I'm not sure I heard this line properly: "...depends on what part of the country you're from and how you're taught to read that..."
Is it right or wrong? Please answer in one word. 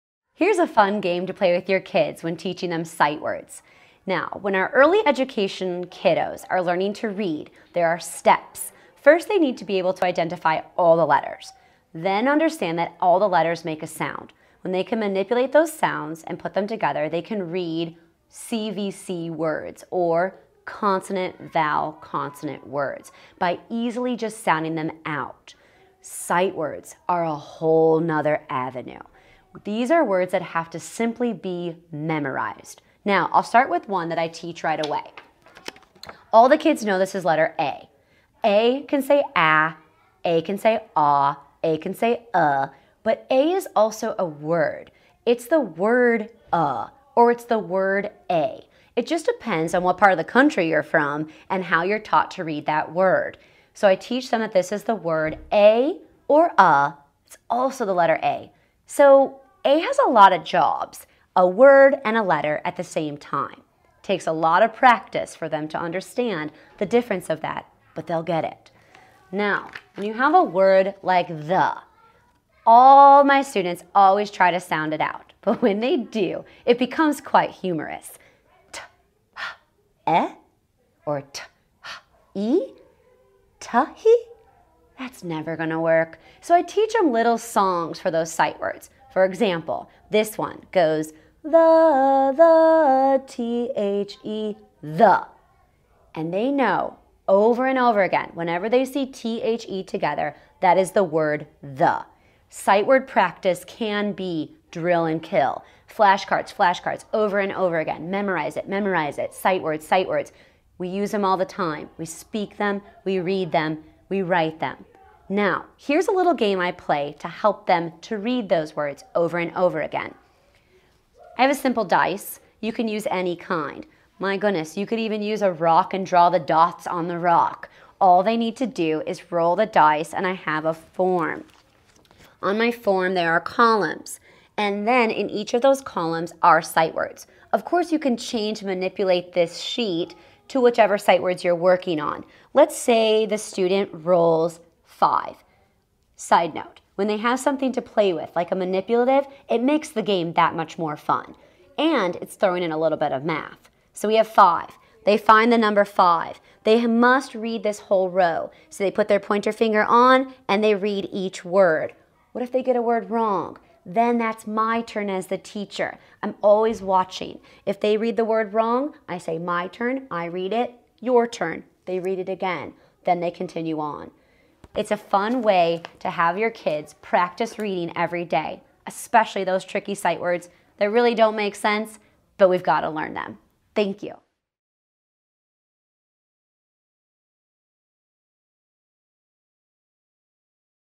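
right.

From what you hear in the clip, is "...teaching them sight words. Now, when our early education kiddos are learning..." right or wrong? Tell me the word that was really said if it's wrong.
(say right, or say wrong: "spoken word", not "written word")
right.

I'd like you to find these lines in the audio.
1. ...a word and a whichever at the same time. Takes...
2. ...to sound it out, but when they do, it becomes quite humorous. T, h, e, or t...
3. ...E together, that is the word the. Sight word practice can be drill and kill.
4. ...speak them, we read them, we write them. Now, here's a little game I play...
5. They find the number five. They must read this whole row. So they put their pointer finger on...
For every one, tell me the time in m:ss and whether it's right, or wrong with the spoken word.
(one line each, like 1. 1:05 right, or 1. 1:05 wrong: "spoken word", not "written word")
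1. 1:01 wrong: "letter", not "whichever"
2. 1:14 right
3. 1:39 right
4. 1:52 right
5. 2:35 right.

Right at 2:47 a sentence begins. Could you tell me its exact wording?
If they read the word wrong, I say my turn, I read it, your turn.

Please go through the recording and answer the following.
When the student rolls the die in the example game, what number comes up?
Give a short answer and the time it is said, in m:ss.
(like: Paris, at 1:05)
5, at 2:23.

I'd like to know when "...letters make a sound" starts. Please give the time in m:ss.
0:13.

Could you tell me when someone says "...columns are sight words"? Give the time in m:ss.
2:15.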